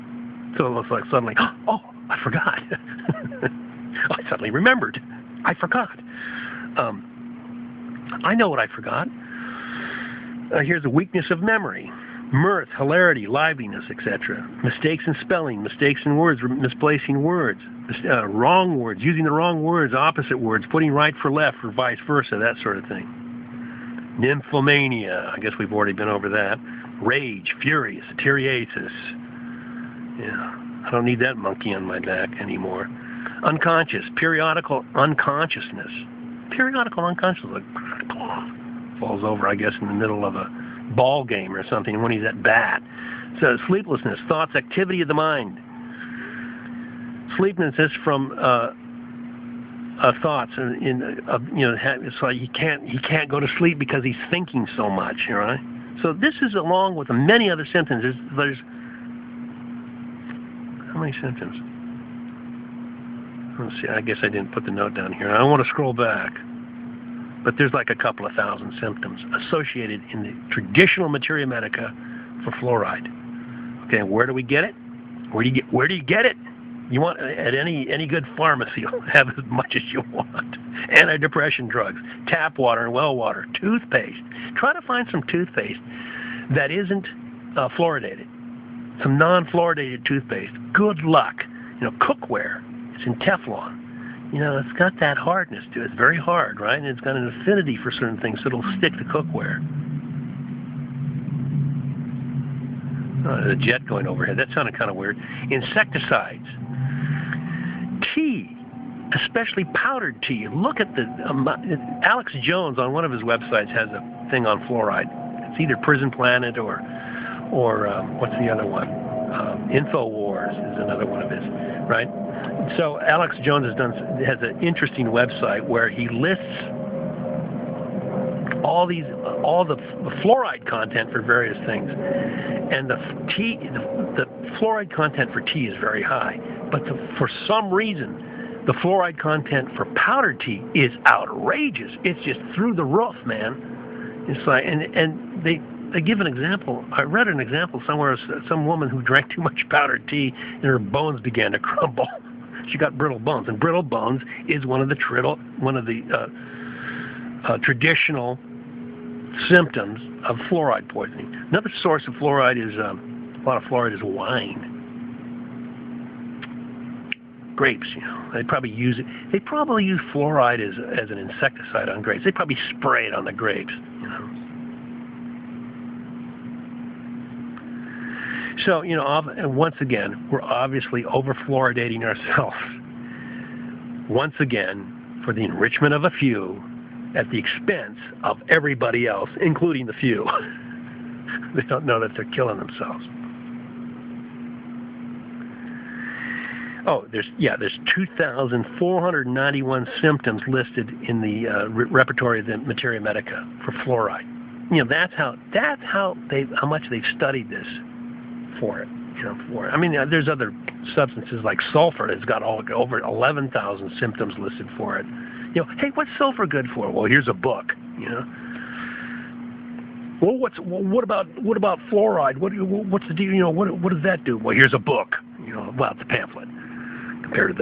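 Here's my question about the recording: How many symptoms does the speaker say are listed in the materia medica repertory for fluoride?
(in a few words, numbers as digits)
2,491.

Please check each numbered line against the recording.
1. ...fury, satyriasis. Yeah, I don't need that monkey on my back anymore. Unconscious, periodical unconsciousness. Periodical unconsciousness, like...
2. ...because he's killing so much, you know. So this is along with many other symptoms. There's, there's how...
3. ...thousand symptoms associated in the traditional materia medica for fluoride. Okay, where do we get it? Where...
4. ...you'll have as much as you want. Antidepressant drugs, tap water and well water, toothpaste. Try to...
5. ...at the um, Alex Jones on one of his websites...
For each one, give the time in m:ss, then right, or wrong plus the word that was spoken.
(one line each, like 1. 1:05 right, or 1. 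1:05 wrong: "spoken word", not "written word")
1. 0:27 right
2. 0:53 wrong: "thinking", not "killing"
3. 1:08 right
4. 1:18 right
5. 1:50 right.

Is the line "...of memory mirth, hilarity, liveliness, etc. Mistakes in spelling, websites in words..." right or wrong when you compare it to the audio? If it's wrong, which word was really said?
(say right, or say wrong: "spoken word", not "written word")
wrong: "mistakes", not "websites".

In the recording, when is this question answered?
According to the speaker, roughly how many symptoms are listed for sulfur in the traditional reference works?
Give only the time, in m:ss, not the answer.
3:32.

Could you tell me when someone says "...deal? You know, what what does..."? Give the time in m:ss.
3:43.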